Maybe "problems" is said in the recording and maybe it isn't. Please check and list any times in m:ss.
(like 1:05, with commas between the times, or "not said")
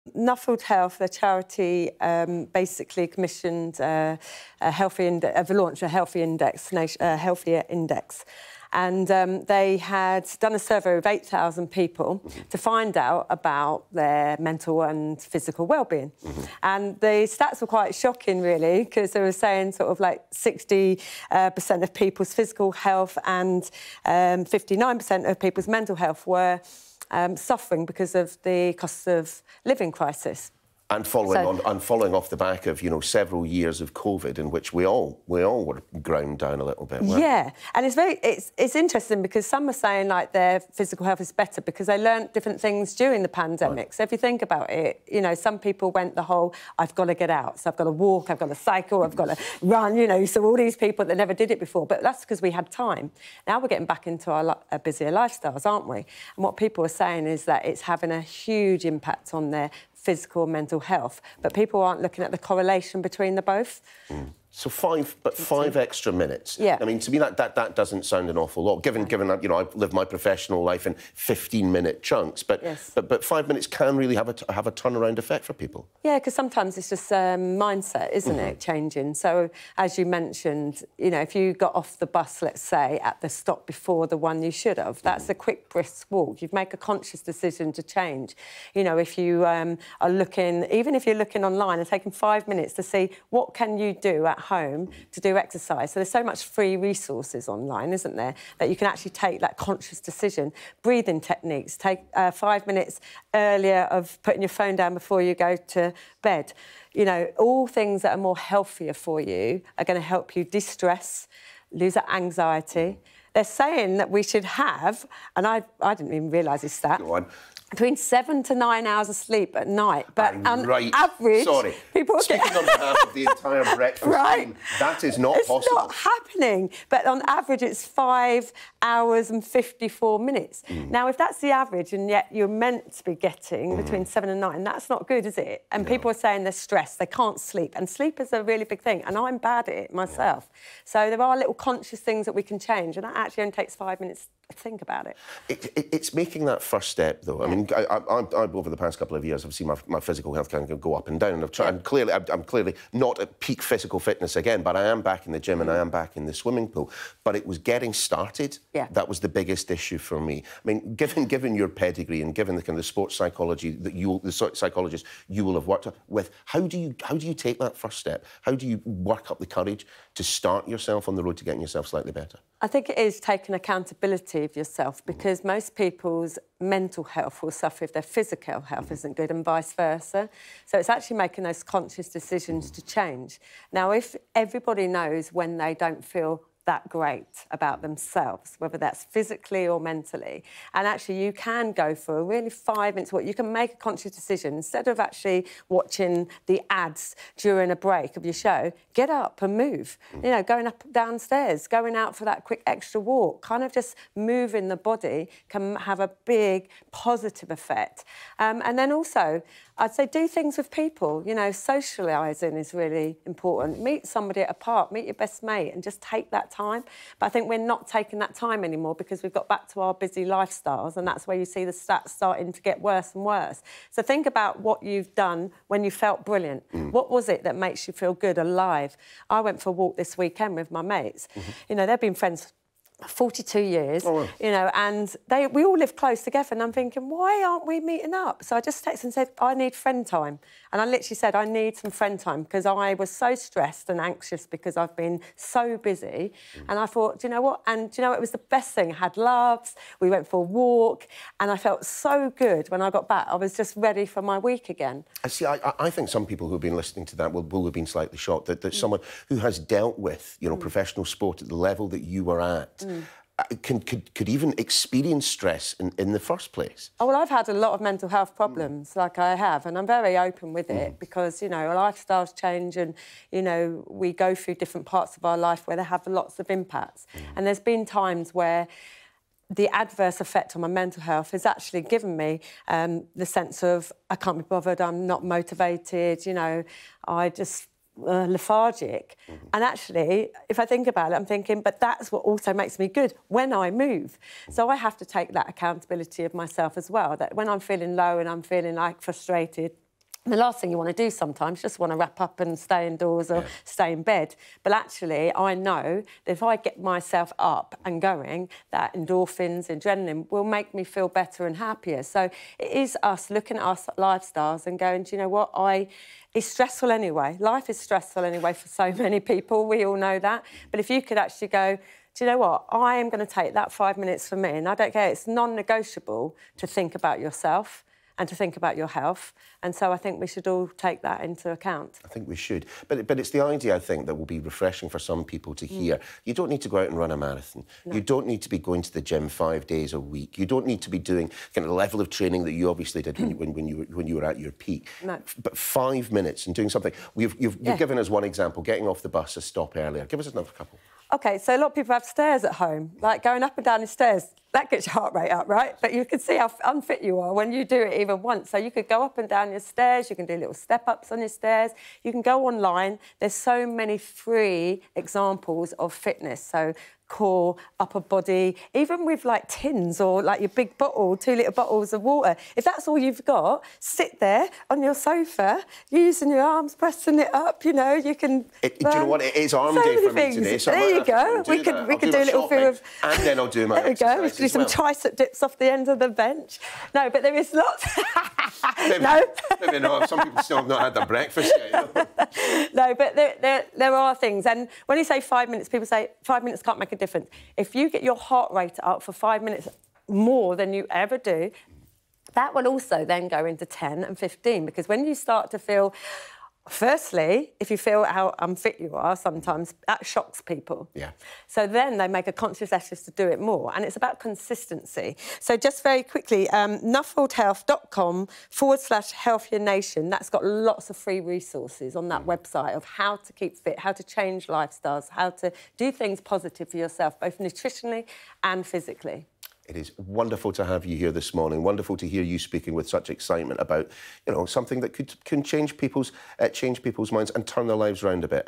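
4:28.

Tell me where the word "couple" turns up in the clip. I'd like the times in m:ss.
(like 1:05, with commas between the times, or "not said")
2:28, 5:50.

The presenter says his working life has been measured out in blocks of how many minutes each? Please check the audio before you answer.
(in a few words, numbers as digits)
15.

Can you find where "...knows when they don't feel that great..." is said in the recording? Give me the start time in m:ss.
3:04.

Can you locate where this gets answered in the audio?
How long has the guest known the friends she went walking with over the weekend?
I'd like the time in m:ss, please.
3:53.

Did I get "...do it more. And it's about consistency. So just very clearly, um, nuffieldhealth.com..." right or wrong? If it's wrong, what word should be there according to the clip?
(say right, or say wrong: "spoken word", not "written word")
wrong: "quickly", not "clearly".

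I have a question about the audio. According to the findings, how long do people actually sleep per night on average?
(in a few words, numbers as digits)
5 hours 54 minutes.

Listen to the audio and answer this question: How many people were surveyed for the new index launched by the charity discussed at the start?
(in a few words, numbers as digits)
8,000.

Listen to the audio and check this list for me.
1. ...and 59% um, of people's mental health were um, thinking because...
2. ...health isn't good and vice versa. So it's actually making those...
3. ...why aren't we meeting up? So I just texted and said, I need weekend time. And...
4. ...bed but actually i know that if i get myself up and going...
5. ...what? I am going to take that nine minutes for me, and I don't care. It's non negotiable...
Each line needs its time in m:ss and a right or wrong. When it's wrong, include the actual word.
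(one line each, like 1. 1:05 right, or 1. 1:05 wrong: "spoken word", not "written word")
1. 0:23 wrong: "suffering", not "thinking"
2. 2:58 right
3. 3:57 wrong: "friend", not "weekend"
4. 5:04 right
5. 5:22 wrong: "five", not "nine".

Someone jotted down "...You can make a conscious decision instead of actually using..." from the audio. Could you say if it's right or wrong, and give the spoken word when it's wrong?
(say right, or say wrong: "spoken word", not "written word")
wrong: "watching", not "using".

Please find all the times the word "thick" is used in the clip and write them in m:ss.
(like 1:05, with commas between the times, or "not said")
not said.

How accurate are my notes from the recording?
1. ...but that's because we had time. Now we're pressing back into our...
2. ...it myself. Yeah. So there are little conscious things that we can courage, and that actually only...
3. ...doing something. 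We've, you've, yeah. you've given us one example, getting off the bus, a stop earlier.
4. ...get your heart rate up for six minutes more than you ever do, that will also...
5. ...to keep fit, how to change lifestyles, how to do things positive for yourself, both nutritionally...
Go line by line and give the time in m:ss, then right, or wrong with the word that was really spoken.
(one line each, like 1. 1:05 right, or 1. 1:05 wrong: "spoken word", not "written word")
1. 0:51 wrong: "getting", not "pressing"
2. 2:19 wrong: "change", not "courage"
3. 5:46 right
4. 6:37 wrong: "five", not "six"
5. 7:03 right.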